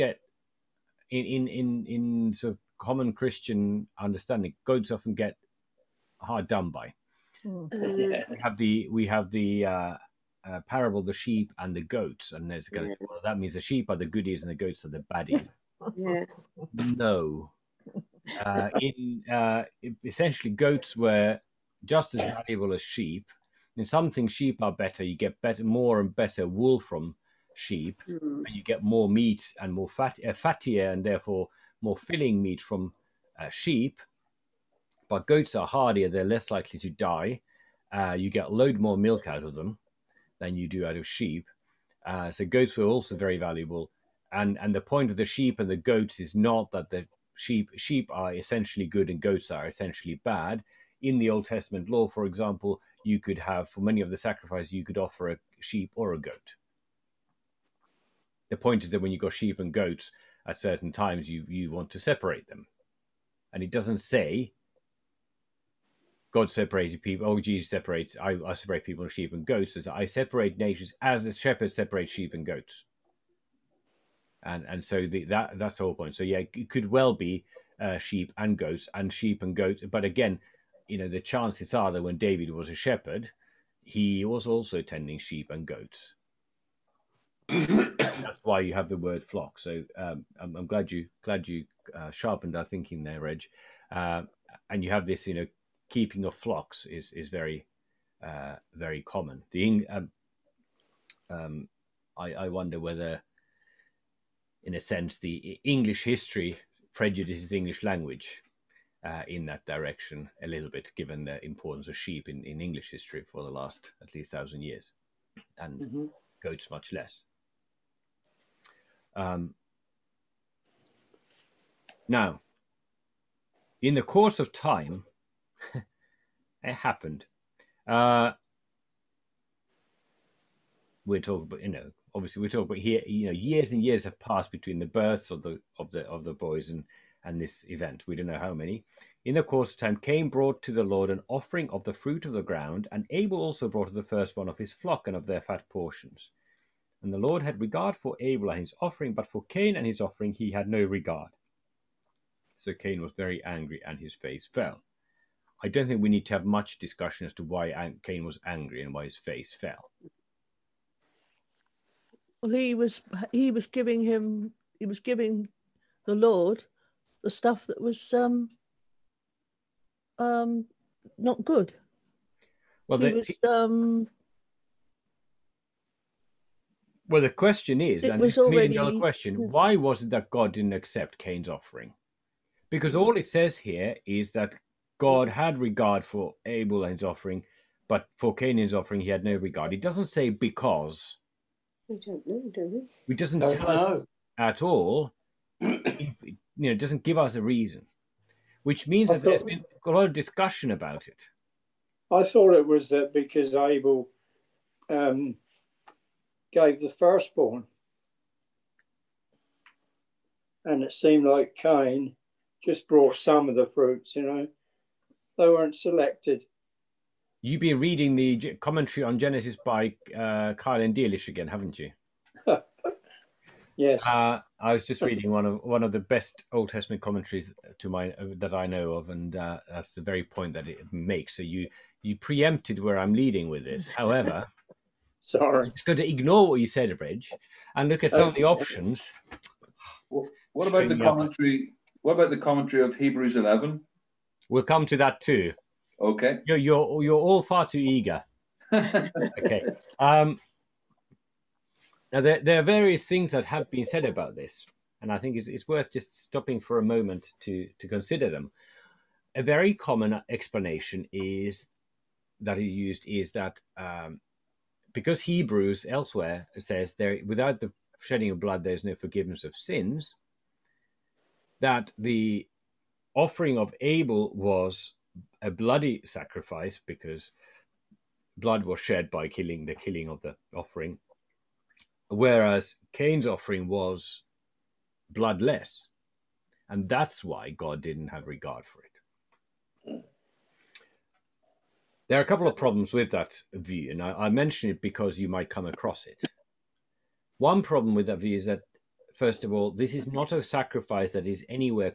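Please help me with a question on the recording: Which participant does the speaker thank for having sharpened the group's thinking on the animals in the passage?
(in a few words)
Reg.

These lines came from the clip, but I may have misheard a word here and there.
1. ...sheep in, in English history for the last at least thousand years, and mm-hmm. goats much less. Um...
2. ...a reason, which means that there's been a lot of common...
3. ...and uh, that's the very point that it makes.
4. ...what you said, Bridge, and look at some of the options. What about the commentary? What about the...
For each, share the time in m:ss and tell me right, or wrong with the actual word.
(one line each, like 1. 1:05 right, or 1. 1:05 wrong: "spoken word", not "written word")
1. 1:51 right
2. 3:17 wrong: "discussion", not "common"
3. 3:49 right
4. 3:56 right.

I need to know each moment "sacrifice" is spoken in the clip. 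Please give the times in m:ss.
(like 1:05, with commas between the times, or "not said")
0:54, 4:36, 5:00.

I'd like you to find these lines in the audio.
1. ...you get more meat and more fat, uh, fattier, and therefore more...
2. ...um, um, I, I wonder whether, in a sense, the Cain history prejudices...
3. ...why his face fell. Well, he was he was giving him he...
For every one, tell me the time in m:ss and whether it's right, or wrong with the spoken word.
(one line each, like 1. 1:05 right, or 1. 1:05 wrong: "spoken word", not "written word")
1. 0:28 right
2. 1:39 wrong: "English", not "Cain"
3. 2:38 right.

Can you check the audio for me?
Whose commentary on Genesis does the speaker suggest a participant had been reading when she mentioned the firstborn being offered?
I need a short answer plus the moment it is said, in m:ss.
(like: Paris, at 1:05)
Keil and Delitzsch, at 3:40.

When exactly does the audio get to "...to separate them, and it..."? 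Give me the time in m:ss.
1:01.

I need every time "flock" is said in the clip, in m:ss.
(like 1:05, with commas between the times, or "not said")
1:29, 1:36, 2:24.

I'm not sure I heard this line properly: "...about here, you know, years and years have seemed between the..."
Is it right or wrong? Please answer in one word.
wrong.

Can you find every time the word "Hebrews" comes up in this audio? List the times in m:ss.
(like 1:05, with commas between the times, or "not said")
4:02, 4:25.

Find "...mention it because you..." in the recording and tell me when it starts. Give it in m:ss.
4:54.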